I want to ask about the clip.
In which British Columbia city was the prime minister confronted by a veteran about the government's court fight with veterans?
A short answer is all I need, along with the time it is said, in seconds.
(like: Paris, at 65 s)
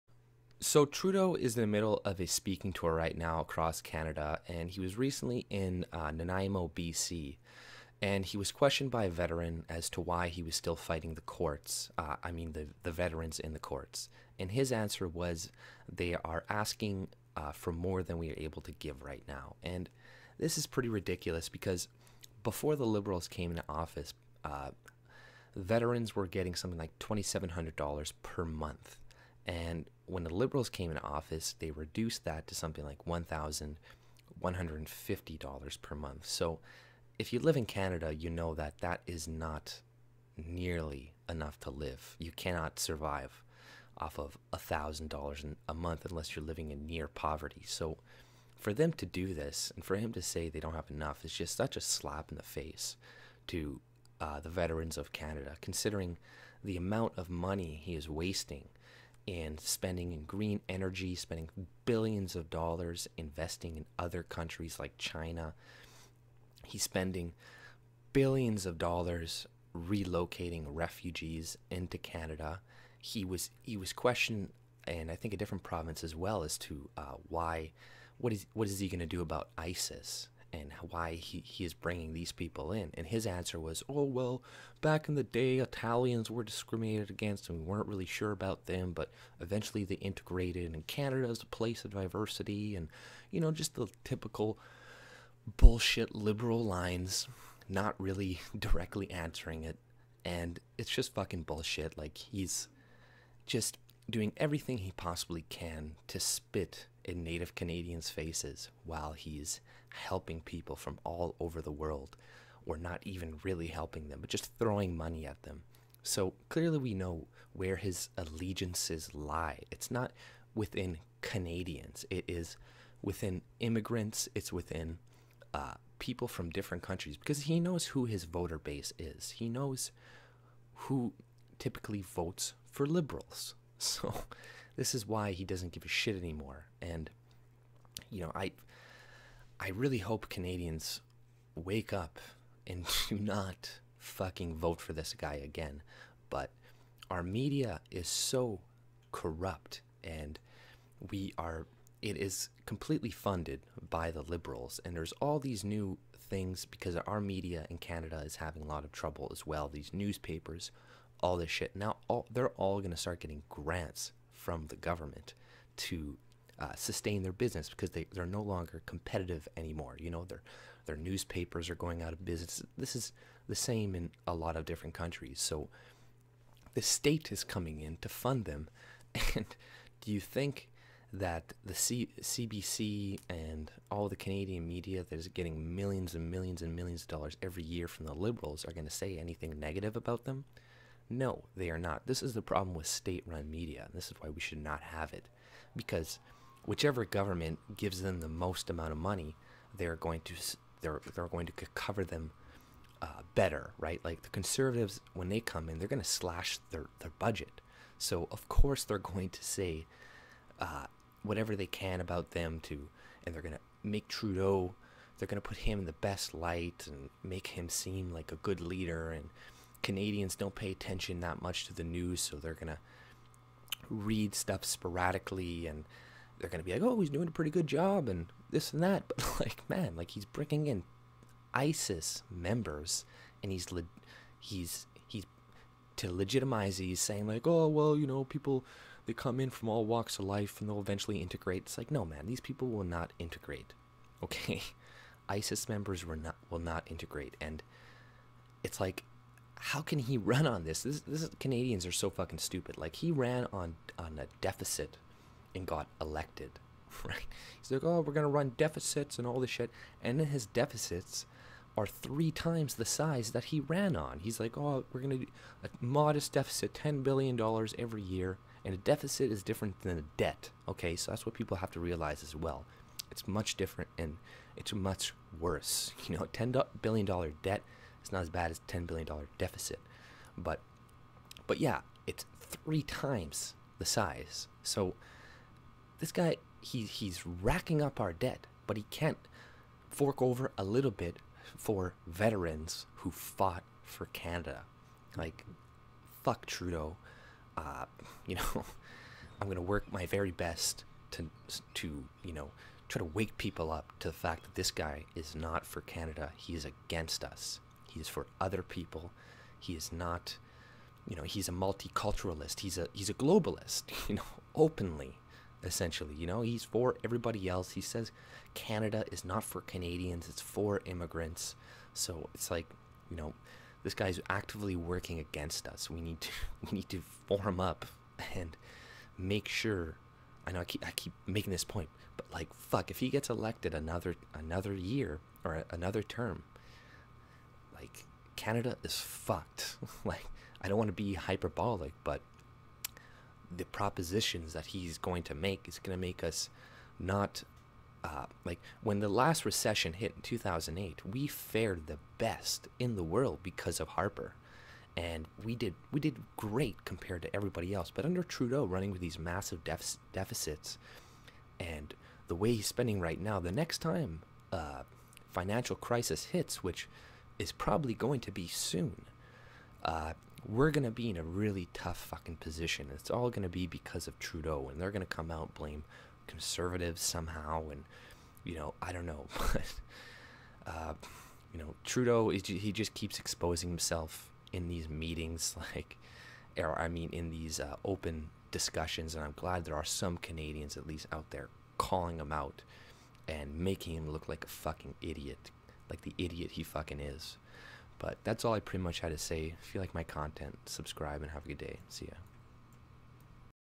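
Nanaimo, at 6 s.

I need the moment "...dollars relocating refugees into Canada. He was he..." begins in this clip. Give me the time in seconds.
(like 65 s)
68 s.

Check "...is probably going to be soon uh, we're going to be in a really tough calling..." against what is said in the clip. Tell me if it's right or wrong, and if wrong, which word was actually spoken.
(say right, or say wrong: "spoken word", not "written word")
wrong: "fucking", not "calling".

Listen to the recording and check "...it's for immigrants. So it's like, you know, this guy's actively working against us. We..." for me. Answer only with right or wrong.
right.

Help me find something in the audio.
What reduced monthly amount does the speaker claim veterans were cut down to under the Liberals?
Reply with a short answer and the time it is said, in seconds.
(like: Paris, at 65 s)
$1,150, at 33 s.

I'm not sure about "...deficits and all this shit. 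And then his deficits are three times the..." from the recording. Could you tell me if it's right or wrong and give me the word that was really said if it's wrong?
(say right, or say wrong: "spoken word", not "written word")
right.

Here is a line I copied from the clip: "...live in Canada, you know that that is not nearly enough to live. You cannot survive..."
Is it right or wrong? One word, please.
right.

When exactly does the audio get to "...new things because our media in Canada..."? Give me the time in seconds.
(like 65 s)
155 s.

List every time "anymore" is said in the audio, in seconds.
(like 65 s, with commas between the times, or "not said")
136 s, 169 s.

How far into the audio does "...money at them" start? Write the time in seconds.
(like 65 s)
114 s.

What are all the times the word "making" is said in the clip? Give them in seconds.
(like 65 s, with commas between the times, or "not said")
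331 s, 393 s.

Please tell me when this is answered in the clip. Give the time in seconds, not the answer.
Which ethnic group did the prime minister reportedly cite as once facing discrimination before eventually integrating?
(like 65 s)
85 s.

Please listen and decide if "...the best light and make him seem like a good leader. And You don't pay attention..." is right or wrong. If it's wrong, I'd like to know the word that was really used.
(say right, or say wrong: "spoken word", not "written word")
wrong: "Canadians", not "You".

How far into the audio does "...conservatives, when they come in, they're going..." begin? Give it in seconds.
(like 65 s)
204 s.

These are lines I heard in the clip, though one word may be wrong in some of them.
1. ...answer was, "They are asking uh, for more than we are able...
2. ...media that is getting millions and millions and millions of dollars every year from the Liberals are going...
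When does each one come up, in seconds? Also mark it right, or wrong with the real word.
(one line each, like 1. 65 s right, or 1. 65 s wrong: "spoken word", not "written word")
1. 14 s right
2. 184 s right.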